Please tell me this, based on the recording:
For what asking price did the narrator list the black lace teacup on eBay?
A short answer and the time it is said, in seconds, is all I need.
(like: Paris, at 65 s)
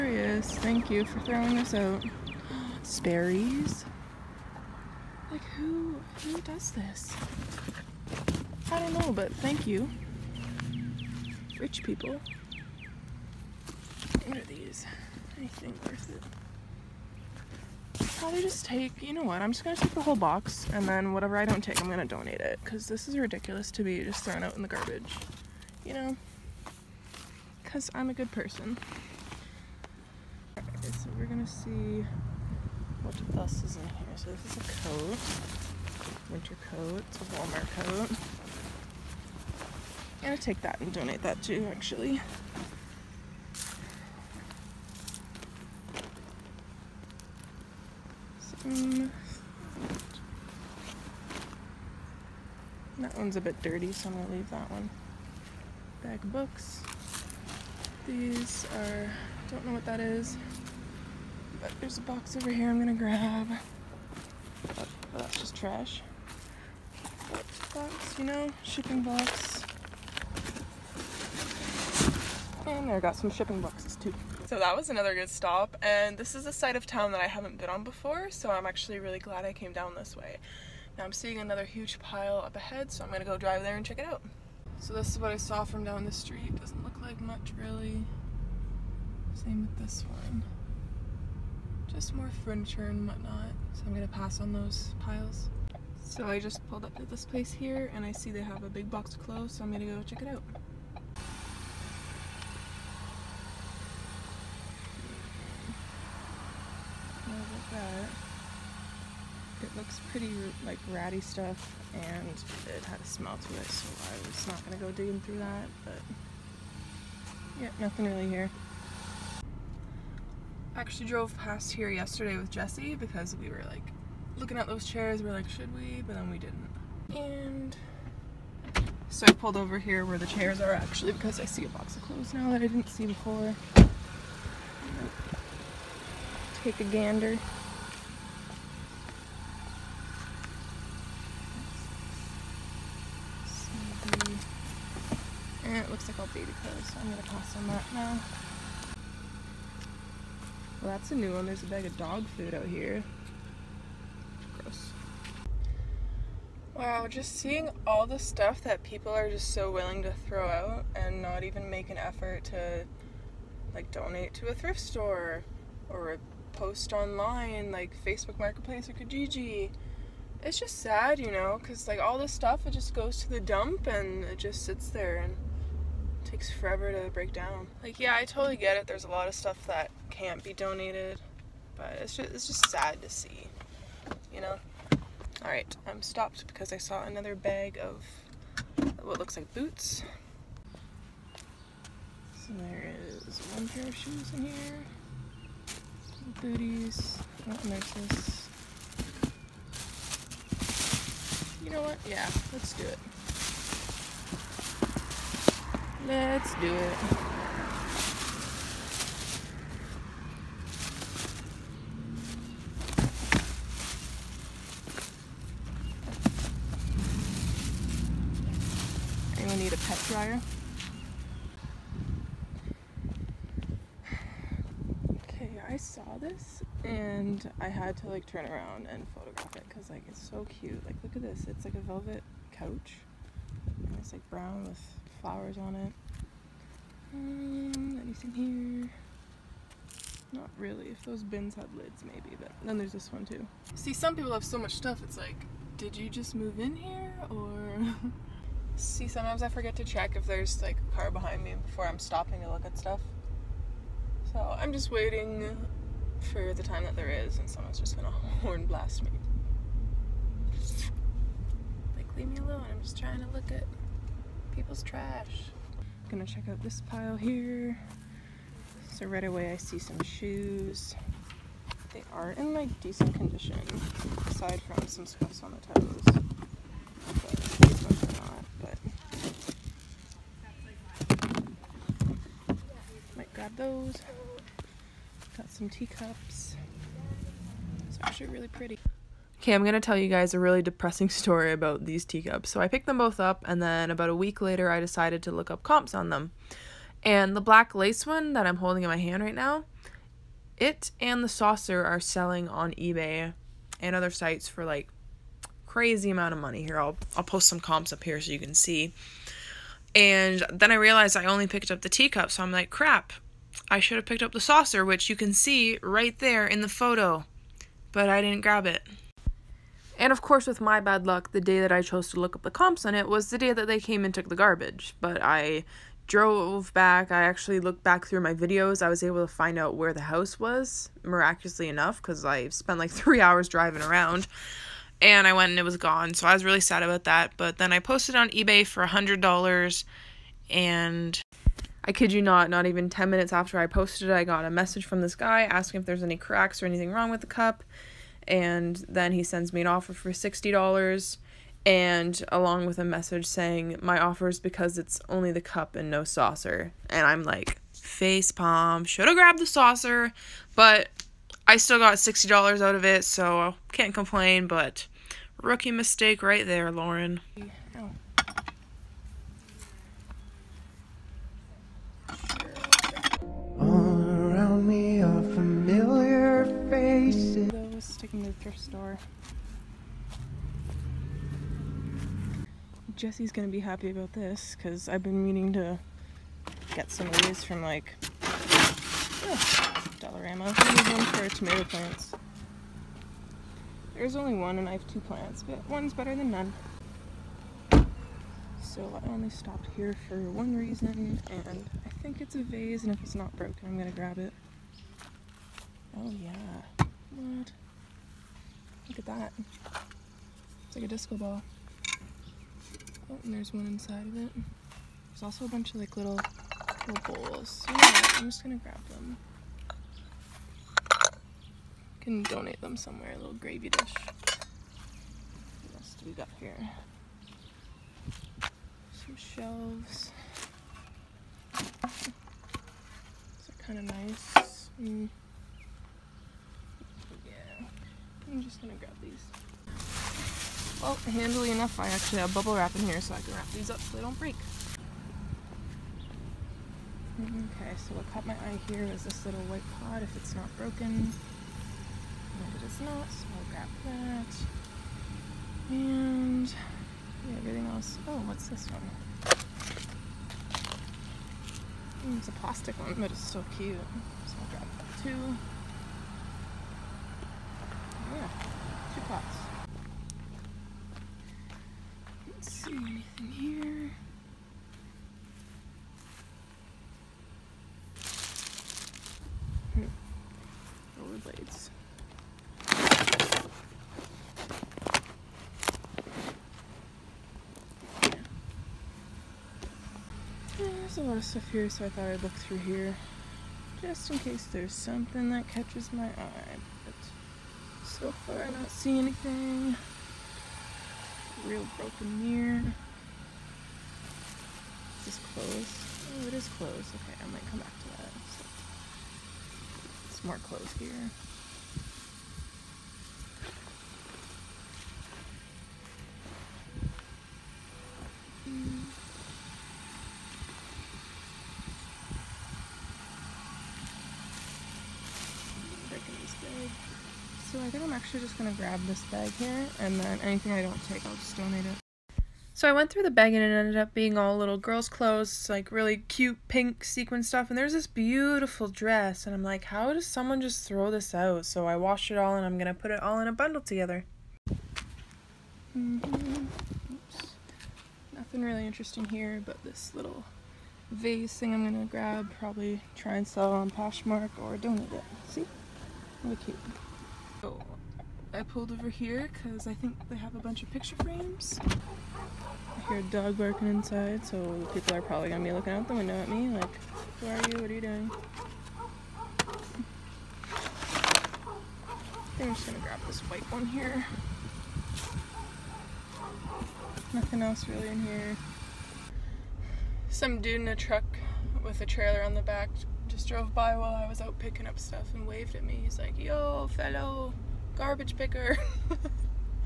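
$100, at 338 s.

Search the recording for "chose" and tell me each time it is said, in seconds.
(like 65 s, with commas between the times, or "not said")
321 s.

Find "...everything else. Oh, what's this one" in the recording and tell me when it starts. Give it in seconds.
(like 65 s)
457 s.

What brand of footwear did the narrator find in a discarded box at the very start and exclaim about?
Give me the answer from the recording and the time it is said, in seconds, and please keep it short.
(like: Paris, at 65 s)
Sperry's, at 2 s.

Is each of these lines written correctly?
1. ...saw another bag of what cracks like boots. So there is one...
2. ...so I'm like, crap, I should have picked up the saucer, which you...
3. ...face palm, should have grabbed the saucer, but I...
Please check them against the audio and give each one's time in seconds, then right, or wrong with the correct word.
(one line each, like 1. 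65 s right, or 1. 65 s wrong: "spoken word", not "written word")
1. 186 s wrong: "looks", not "cracks"
2. 312 s right
3. 357 s right.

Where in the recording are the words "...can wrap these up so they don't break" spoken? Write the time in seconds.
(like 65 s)
443 s.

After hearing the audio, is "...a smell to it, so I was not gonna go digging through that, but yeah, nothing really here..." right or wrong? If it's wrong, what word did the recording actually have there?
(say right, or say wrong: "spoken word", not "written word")
right.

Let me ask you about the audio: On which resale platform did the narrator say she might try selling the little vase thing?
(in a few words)
Poshmark.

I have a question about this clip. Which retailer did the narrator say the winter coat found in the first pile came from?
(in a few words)
Walmart.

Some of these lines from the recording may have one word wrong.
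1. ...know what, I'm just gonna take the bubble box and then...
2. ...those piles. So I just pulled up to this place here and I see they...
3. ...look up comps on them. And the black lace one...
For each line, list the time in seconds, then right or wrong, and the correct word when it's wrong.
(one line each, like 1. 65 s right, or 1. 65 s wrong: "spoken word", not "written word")
1. 19 s wrong: "whole", not "bubble"
2. 94 s right
3. 295 s right.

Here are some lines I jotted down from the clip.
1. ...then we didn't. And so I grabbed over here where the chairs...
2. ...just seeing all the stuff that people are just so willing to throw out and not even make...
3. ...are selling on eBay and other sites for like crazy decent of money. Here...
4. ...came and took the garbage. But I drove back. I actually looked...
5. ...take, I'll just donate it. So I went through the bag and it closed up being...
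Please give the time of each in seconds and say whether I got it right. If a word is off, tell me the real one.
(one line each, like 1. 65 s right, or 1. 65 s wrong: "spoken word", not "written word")
1. 126 s wrong: "pulled", not "grabbed"
2. 157 s right
3. 301 s wrong: "amount", not "decent"
4. 323 s right
5. 530 s wrong: "ended", not "closed".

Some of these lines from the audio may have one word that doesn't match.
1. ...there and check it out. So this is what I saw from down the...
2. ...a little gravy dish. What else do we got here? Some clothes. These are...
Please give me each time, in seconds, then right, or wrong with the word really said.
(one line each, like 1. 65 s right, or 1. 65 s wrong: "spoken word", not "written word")
1. 83 s right
2. 423 s wrong: "shelves", not "clothes".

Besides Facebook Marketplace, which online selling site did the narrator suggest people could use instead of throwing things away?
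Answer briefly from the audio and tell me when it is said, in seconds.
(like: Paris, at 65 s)
Kijiji, at 168 s.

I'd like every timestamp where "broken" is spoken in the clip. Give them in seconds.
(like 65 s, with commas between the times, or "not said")
403 s, 450 s, 501 s.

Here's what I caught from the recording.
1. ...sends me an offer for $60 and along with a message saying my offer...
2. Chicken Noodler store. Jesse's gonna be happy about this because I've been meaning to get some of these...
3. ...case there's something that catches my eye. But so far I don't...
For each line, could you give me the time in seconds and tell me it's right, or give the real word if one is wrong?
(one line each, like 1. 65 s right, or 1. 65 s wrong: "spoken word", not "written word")
1. 349 s right
2. 378 s right
3. 494 s right.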